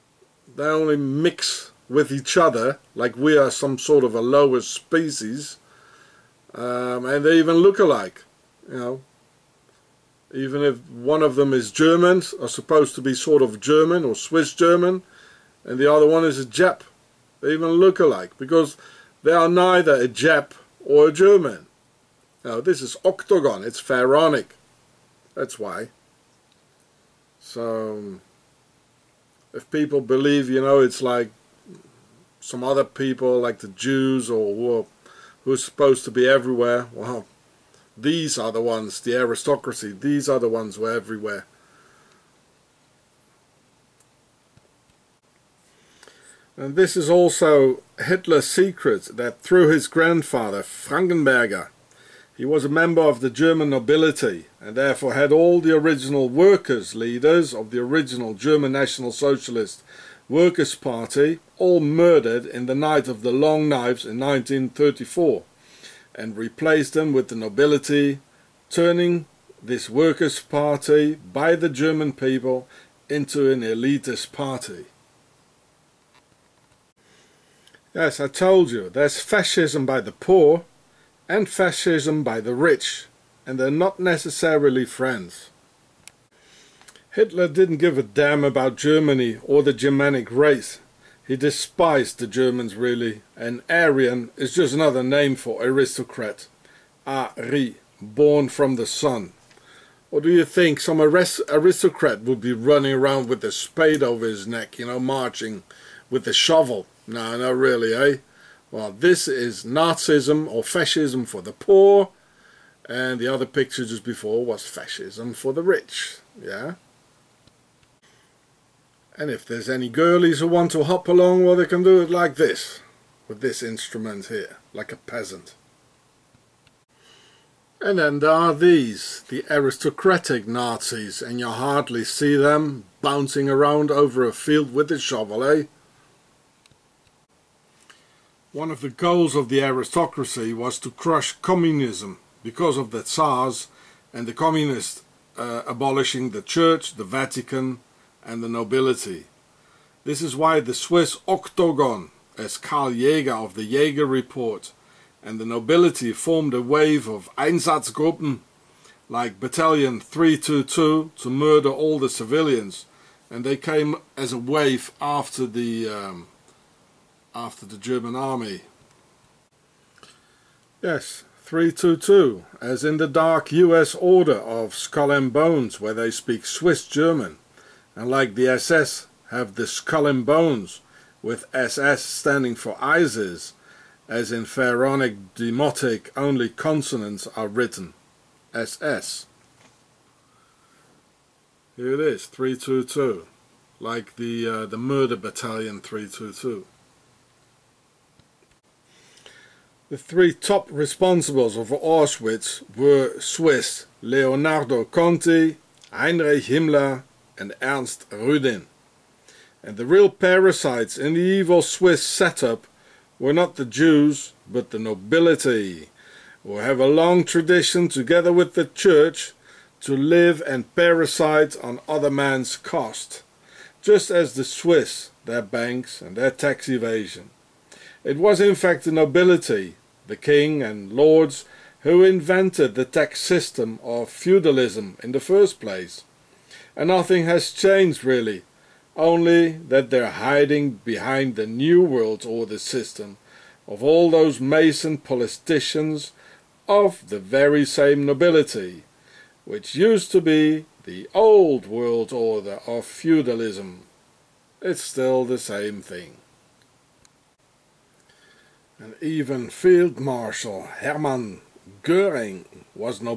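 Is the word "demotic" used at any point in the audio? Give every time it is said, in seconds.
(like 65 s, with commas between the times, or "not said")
185 s.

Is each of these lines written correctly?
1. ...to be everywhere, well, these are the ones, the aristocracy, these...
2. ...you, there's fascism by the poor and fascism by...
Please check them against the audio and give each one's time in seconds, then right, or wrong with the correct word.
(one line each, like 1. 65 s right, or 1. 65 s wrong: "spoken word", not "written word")
1. 36 s right
2. 78 s right.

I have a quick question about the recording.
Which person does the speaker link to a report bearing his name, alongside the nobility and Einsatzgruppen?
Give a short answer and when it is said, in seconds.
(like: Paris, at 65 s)
Karl Jaeger, at 152 s.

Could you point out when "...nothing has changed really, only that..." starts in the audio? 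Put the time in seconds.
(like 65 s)
236 s.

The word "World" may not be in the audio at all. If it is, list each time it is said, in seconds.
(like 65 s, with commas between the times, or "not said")
241 s, 251 s.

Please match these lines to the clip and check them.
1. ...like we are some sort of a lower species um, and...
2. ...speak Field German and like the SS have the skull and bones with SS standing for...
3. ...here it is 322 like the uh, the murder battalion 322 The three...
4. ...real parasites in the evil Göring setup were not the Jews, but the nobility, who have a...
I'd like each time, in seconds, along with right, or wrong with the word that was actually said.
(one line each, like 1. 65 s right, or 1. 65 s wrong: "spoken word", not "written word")
1. 2 s right
2. 176 s wrong: "Swiss", not "Field"
3. 191 s right
4. 209 s wrong: "Swiss", not "Göring".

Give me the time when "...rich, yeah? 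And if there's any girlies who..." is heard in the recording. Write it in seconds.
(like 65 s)
115 s.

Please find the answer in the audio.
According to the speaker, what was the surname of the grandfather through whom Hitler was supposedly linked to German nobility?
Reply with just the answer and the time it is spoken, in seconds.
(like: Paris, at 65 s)
Frankenberger, at 50 s.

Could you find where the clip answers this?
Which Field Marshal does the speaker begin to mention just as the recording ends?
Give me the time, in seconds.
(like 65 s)
260 s.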